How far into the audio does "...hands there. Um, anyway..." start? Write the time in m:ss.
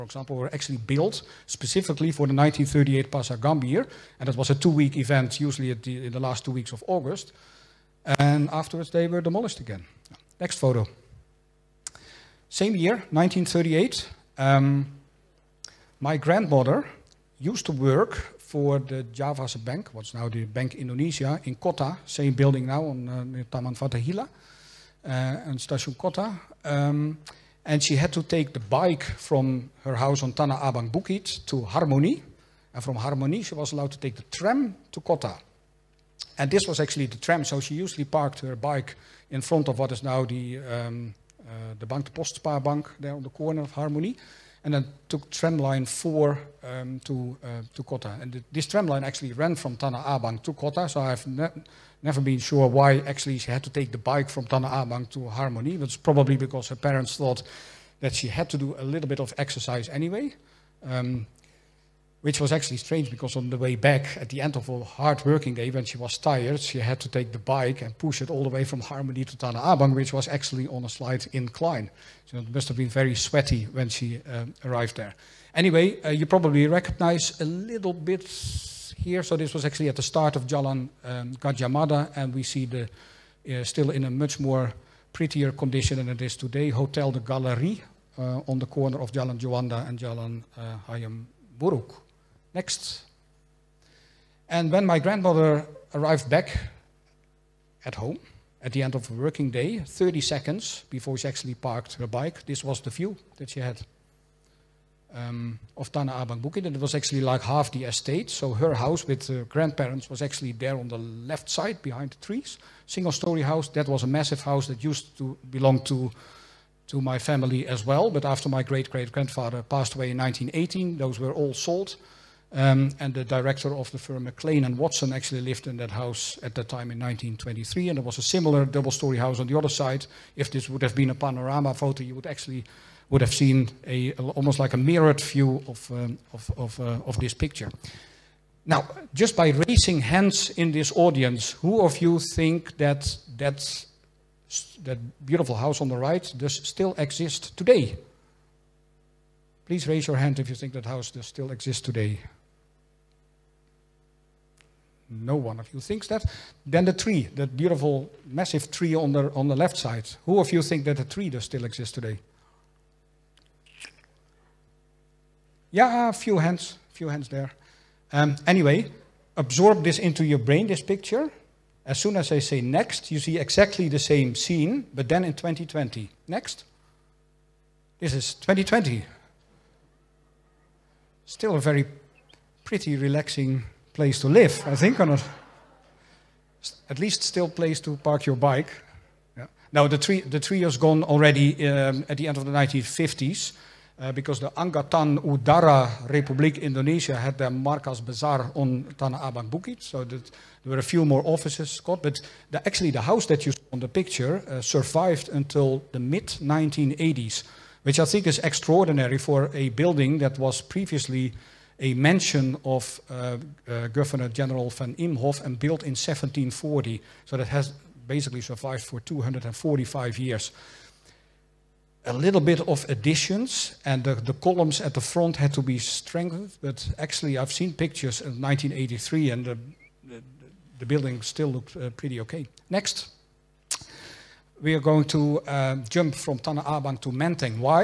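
2:47.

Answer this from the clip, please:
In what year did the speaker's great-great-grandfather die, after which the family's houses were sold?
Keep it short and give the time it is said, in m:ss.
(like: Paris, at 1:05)
1918, at 2:00.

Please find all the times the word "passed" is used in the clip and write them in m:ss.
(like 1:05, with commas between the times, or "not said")
1:59.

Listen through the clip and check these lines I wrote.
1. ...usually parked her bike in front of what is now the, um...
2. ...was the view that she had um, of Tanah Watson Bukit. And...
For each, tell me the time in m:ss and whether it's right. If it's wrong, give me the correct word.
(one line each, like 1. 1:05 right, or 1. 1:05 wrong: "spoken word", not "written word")
1. 0:37 right
2. 1:42 wrong: "Abang", not "Watson".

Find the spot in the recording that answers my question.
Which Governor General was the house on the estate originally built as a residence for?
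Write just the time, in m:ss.
3:34.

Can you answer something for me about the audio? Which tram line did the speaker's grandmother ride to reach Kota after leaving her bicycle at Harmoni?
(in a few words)
Tramline 4.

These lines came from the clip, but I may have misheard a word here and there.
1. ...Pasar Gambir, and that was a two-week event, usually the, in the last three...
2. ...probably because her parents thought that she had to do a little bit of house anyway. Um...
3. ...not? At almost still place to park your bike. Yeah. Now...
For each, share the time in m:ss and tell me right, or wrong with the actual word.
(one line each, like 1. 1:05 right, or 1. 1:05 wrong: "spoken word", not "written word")
1. 0:03 wrong: "two", not "three"
2. 0:56 wrong: "exercise", not "house"
3. 3:05 wrong: "least", not "almost".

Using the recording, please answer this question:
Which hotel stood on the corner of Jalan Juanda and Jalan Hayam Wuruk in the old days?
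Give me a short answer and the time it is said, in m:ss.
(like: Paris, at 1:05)
Hotel des Galeries, at 1:26.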